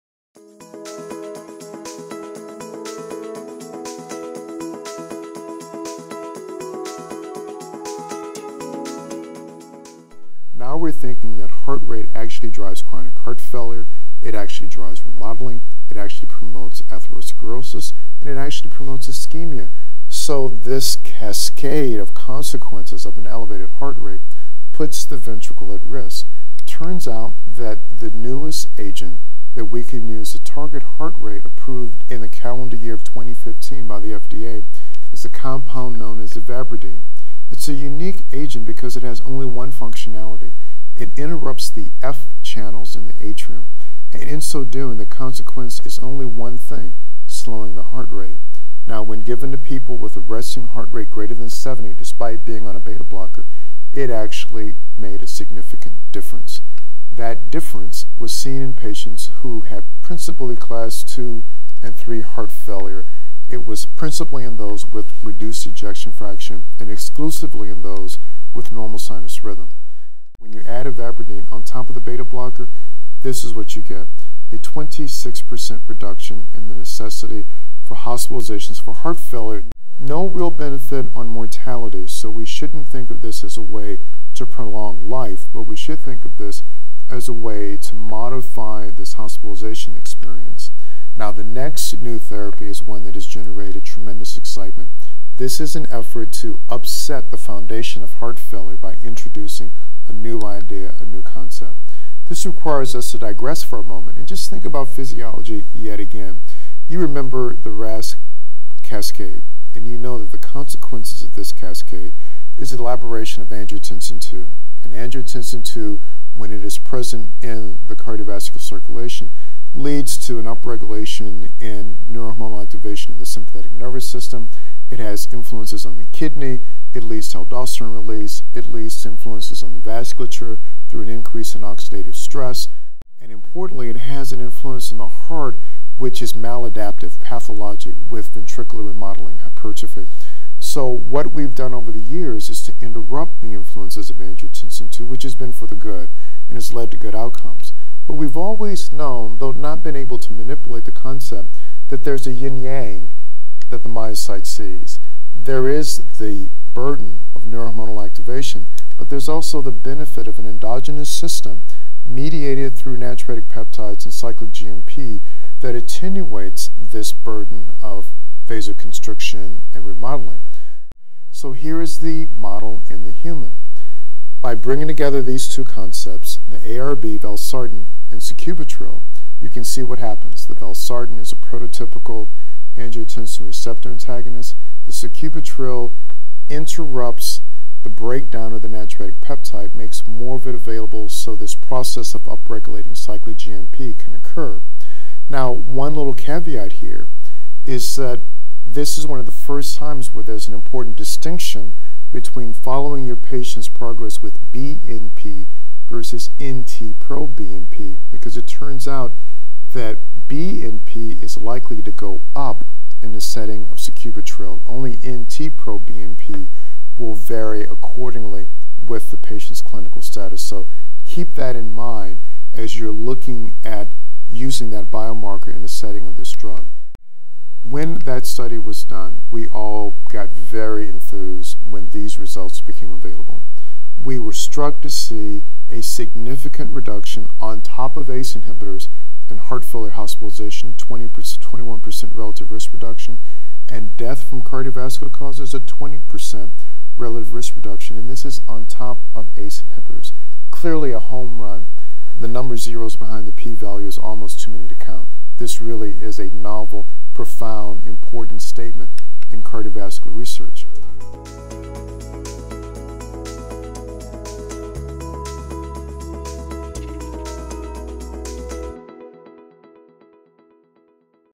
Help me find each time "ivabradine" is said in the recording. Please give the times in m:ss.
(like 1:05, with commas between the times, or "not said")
0:36, 1:10.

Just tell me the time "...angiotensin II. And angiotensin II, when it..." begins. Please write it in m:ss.
1:53.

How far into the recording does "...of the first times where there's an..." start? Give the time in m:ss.
3:19.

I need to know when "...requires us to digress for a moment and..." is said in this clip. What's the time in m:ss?
1:42.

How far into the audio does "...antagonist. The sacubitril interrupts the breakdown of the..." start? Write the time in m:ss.
3:03.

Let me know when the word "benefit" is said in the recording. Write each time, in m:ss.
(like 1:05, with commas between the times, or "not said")
1:20, 2:39.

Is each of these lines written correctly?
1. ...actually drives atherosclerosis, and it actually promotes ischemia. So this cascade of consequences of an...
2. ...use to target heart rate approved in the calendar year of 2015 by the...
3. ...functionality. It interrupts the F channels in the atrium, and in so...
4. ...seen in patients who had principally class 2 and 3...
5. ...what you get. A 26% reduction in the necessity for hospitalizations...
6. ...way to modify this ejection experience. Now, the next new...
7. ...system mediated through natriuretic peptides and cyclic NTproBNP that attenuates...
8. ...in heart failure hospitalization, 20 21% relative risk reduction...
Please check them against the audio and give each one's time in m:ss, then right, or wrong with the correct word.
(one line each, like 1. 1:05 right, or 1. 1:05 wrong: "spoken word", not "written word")
1. 0:15 wrong: "promotes", not "drives"
2. 0:30 right
3. 0:39 right
4. 0:58 right
5. 1:13 right
6. 1:27 wrong: "hospitalization", not "ejection"
7. 2:41 wrong: "GMP", not "NTproBNP"
8. 3:59 right.